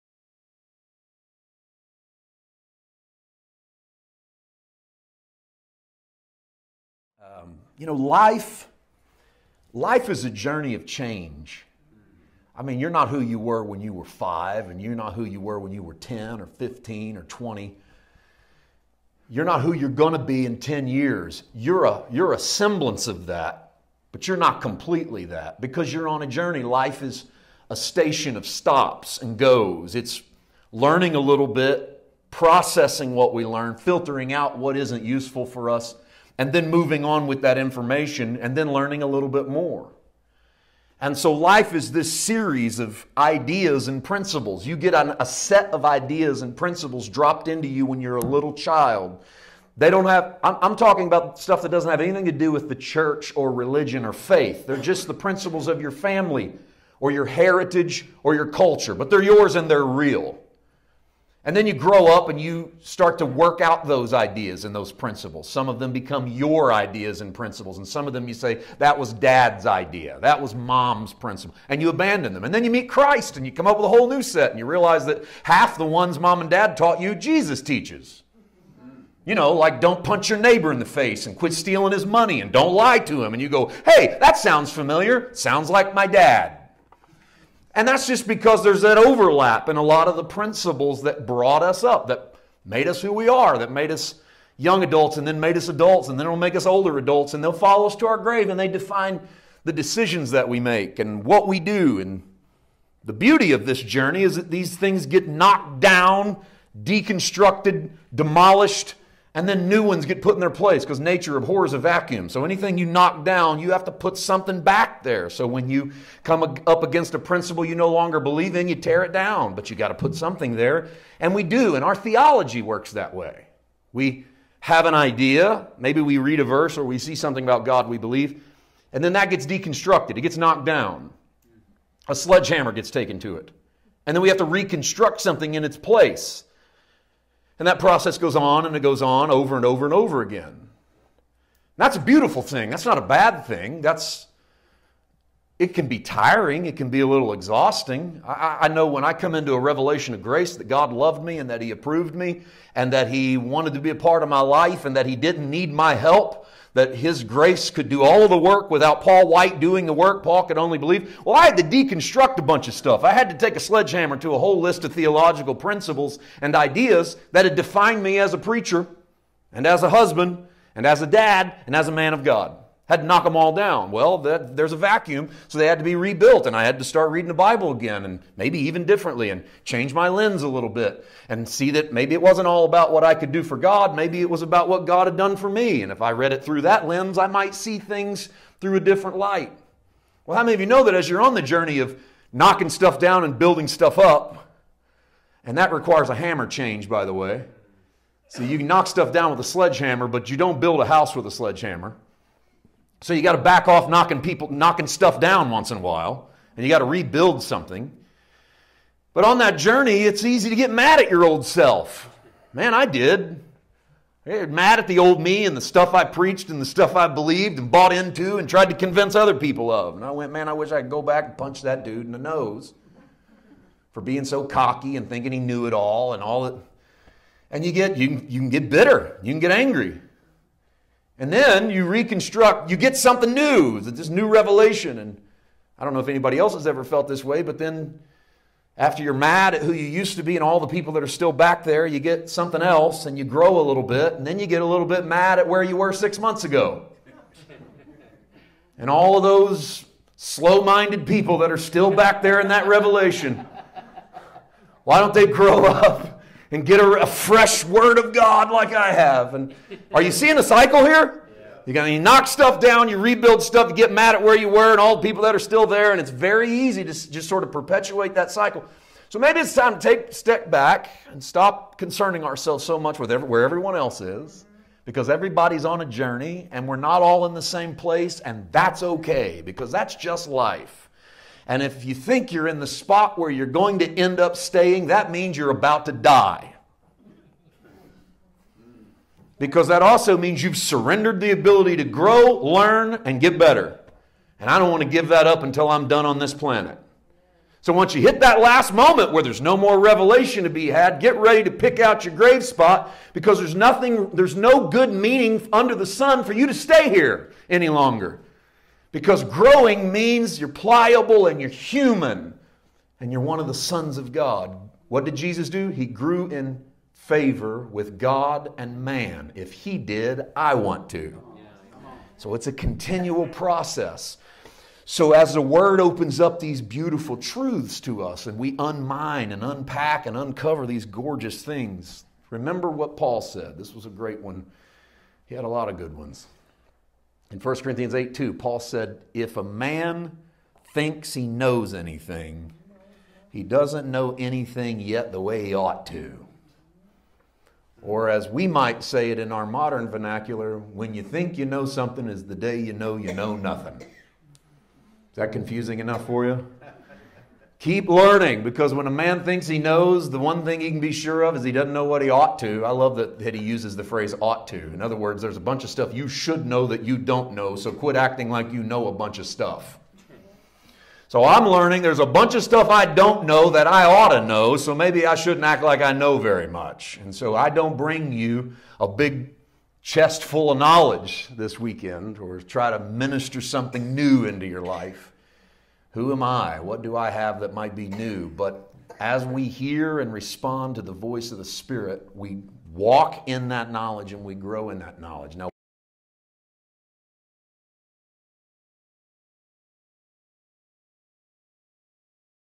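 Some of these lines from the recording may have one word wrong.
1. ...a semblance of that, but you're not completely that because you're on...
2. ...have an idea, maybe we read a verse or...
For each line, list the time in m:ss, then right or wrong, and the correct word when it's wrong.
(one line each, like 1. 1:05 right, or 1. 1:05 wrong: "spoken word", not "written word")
1. 0:22 right
2. 2:04 right.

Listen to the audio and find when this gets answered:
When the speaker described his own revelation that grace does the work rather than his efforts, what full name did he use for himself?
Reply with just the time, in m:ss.
2:39.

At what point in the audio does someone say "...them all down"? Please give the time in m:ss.
2:53.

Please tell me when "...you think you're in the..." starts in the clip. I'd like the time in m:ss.
4:41.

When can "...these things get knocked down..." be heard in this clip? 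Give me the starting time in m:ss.
1:44.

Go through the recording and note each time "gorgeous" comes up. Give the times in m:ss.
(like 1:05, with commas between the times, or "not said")
5:30.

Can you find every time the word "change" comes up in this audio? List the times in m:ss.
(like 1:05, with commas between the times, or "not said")
0:10, 2:59, 3:16.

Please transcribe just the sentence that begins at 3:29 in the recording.
But on that journey, it's easy to get mad at your old self.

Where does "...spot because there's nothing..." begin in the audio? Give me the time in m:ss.
5:02.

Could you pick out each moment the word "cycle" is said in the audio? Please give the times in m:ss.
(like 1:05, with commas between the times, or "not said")
4:20, 4:28.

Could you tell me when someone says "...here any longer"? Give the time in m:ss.
5:06.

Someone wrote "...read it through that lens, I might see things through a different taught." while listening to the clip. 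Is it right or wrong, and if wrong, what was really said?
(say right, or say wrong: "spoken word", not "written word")
wrong: "light", not "taught".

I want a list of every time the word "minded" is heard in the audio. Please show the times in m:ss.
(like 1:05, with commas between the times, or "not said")
4:10.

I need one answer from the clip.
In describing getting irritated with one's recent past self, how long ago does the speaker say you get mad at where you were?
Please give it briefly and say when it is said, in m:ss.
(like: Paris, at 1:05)
6 months ago, at 4:05.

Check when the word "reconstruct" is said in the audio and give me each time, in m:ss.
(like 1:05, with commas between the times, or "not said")
2:14, 3:51.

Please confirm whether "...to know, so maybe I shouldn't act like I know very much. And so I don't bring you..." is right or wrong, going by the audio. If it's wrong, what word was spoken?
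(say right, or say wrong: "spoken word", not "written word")
right.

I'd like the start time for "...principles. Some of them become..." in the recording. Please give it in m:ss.
1:04.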